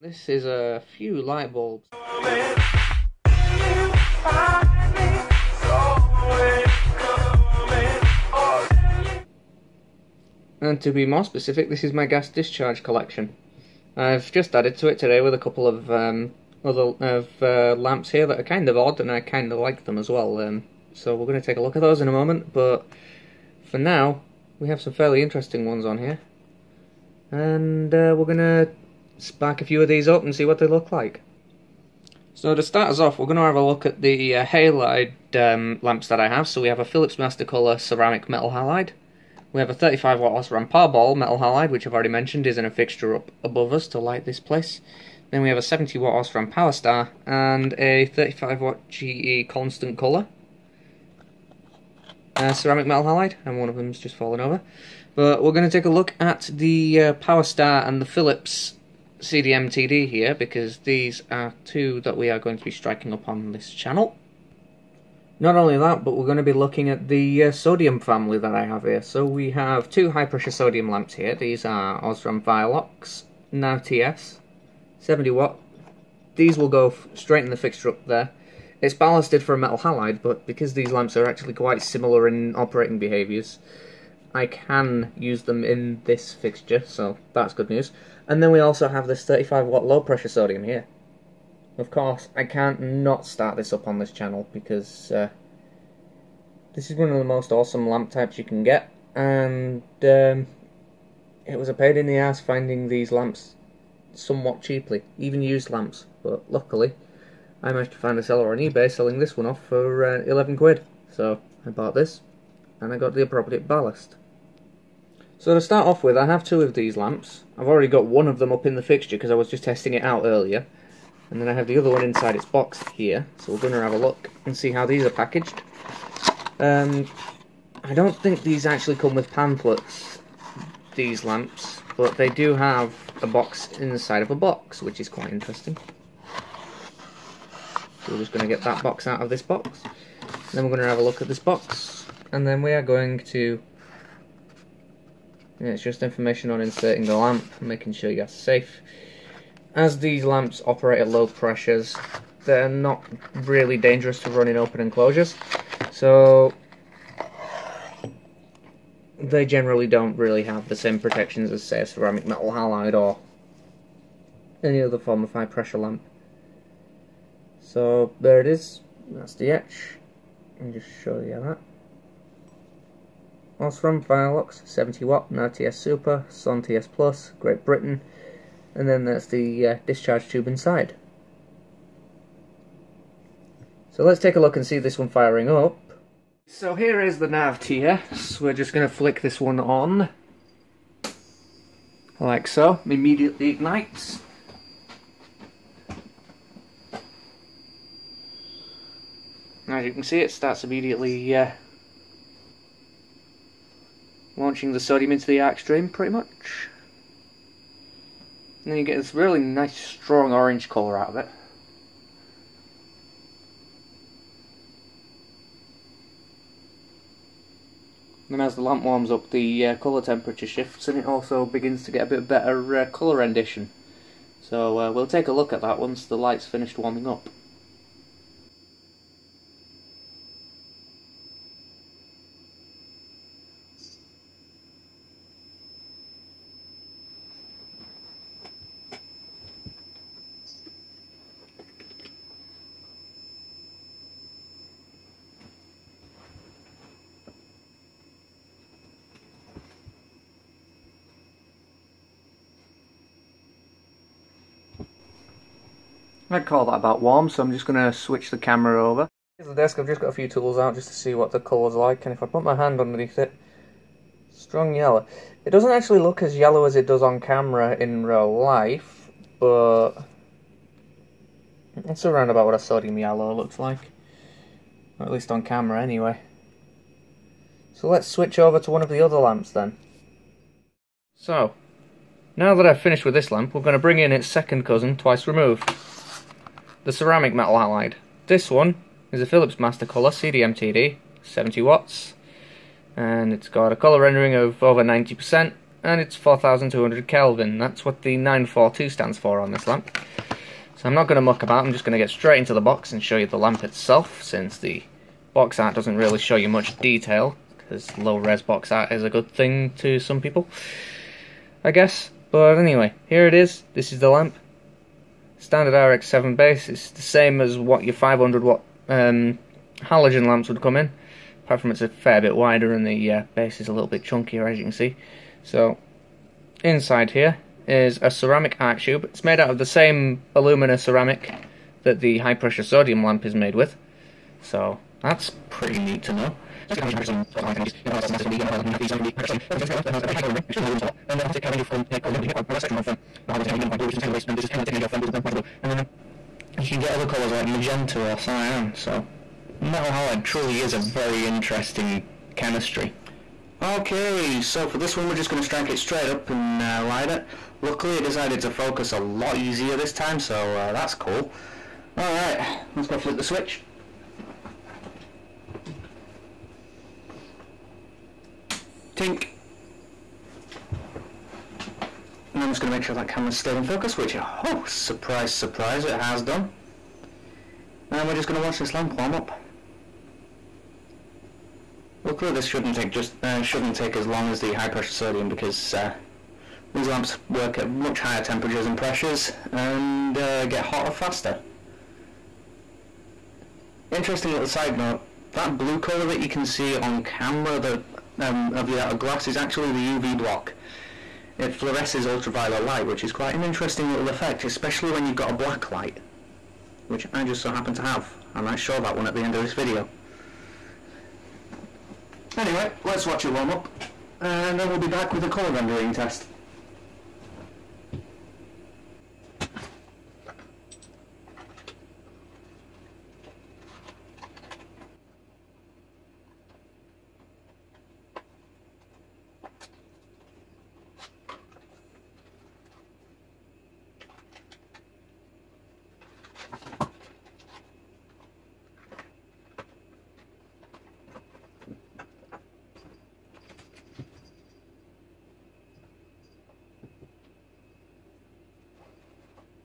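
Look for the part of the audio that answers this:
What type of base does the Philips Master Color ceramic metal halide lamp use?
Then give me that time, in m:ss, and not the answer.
5:15.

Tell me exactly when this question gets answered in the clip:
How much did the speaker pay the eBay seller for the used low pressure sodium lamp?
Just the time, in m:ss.
1:50.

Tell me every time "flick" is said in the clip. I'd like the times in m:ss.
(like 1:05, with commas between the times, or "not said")
3:08, 6:02.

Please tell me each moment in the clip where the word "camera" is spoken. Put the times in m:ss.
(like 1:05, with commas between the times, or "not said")
4:18, 4:27, 4:35, 6:13, 6:37.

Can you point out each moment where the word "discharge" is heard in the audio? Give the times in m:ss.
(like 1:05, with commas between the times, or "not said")
0:12, 2:59.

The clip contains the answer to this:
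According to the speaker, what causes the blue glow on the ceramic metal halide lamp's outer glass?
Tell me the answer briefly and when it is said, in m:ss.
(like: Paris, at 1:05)
UV block, at 6:39.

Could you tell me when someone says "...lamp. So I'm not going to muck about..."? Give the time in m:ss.
4:59.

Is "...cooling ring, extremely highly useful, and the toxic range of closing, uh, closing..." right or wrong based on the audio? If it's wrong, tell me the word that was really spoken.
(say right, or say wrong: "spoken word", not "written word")
right.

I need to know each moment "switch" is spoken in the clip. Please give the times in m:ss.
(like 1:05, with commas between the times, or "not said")
4:17, 4:38, 6:03.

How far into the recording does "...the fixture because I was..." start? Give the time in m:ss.
1:58.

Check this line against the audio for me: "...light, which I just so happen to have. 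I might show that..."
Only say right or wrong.
right.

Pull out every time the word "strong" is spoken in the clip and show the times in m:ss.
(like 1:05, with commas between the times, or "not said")
3:29, 4:24.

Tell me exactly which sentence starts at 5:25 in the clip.
So inside here is a ceramic arc tube.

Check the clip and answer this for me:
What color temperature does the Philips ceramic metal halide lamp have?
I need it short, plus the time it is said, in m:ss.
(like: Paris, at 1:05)
4200 Kelvin, at 4:56.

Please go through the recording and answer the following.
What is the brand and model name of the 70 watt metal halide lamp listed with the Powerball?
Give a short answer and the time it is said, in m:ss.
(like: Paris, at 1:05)
Osram Powerstar, at 0:46.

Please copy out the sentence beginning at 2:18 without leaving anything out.
So we're just going to get that box out of this box.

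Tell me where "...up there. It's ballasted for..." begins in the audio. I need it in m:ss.
1:17.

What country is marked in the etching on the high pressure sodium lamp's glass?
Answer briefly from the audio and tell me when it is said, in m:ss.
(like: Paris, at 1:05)
Great Britain, at 2:57.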